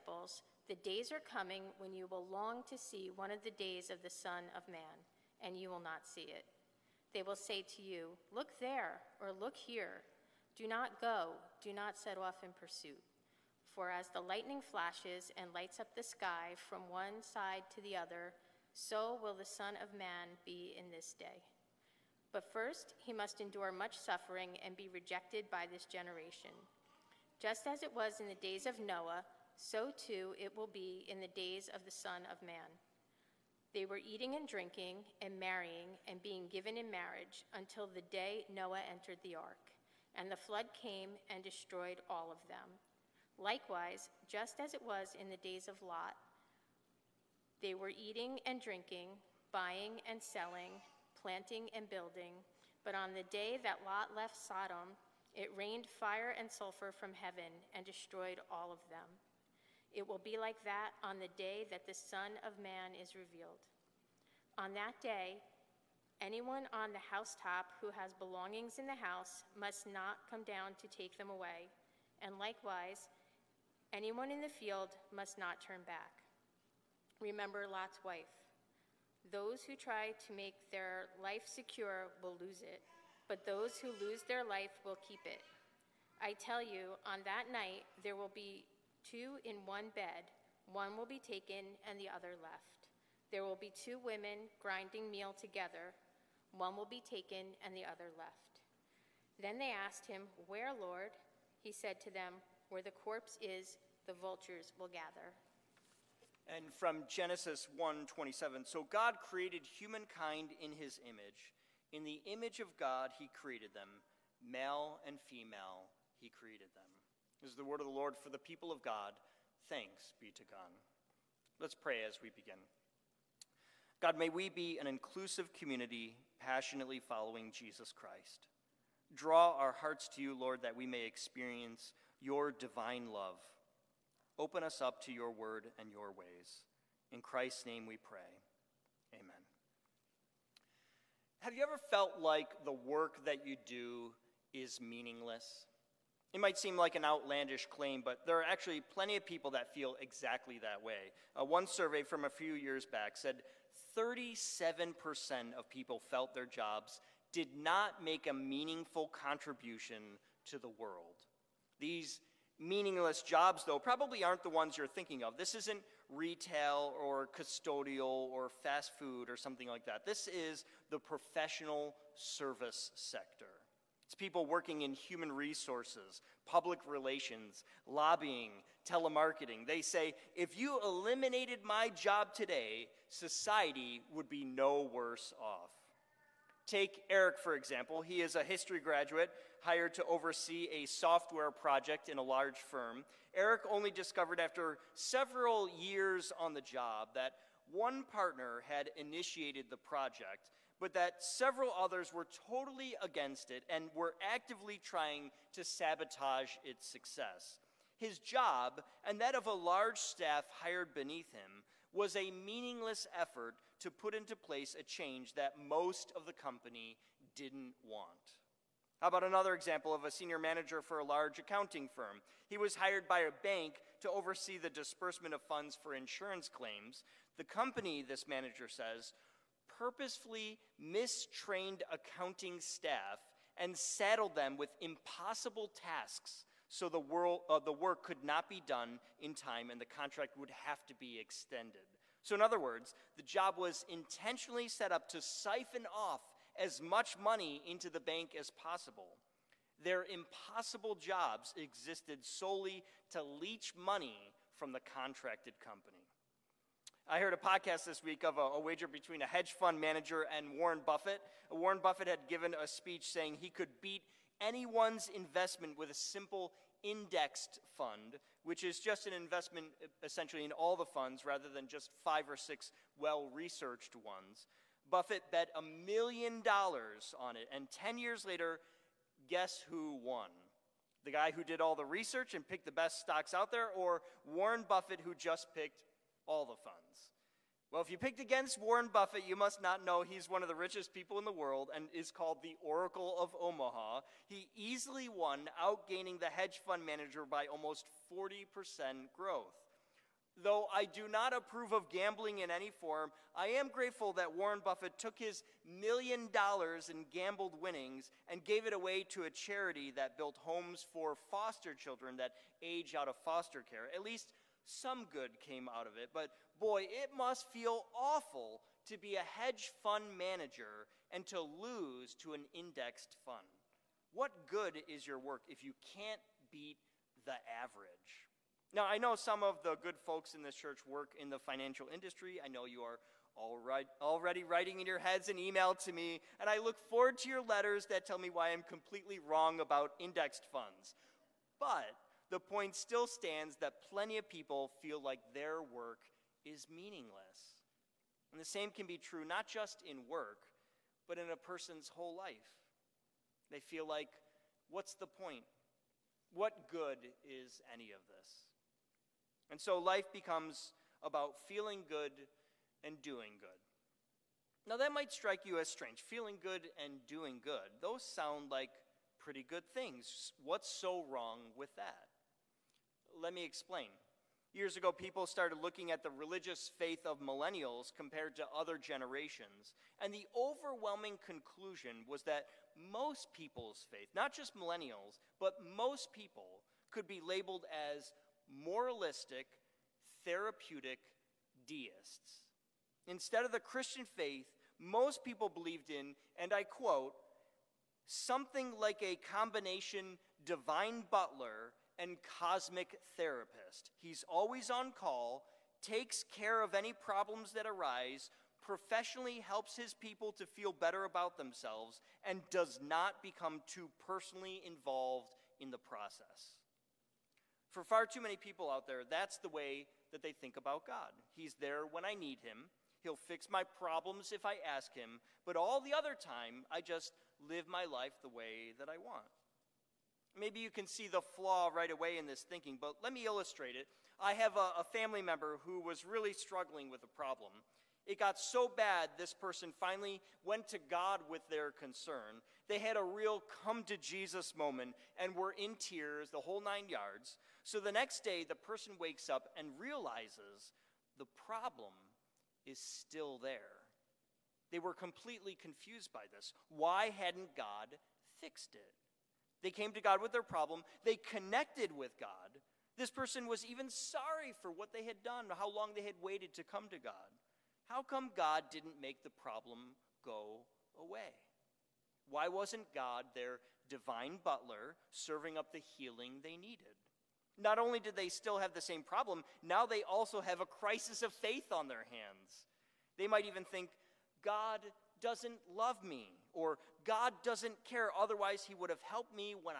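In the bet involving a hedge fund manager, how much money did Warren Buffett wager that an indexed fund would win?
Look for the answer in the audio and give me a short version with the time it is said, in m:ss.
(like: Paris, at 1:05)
A million dollars, at 4:35.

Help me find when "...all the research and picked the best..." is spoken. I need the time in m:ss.
4:41.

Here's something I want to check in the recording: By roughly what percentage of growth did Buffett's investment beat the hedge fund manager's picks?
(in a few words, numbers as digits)
Almost 40%.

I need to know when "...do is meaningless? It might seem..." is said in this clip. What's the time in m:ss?
2:23.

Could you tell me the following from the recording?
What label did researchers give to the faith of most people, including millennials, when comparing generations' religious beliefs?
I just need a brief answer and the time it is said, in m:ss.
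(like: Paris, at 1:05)
Moralistic therapeutic deists, at 6:28.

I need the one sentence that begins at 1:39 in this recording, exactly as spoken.
Then they asked him, Where, Lord?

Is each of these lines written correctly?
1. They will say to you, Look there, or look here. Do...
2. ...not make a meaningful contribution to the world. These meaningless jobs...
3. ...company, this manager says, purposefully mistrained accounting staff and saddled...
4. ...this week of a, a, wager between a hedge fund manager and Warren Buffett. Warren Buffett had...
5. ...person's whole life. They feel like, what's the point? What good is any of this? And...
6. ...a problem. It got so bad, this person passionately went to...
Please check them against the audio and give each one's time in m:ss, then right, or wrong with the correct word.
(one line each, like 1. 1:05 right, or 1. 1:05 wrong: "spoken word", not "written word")
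1. 0:07 right
2. 2:37 right
3. 3:47 right
4. 4:17 right
5. 5:51 right
6. 7:17 wrong: "finally", not "passionately".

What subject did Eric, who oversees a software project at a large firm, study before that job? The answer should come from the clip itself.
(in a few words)
History.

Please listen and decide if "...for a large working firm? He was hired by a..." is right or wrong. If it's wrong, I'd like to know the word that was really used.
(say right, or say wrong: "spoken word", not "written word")
wrong: "accounting", not "working".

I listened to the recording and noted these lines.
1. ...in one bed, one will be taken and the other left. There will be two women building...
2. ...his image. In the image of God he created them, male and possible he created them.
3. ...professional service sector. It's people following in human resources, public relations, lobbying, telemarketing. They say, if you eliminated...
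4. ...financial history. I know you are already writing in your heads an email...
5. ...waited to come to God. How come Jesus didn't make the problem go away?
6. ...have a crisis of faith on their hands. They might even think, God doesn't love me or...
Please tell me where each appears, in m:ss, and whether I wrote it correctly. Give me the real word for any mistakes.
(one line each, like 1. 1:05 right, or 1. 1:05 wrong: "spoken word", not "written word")
1. 1:29 wrong: "grinding", not "building"
2. 1:50 wrong: "female", not "possible"
3. 2:50 wrong: "working", not "following"
4. 5:31 wrong: "industry", not "history"
5. 7:46 wrong: "God", not "Jesus"
6. 8:00 right.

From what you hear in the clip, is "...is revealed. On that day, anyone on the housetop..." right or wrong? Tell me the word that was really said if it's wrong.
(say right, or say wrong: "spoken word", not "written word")
right.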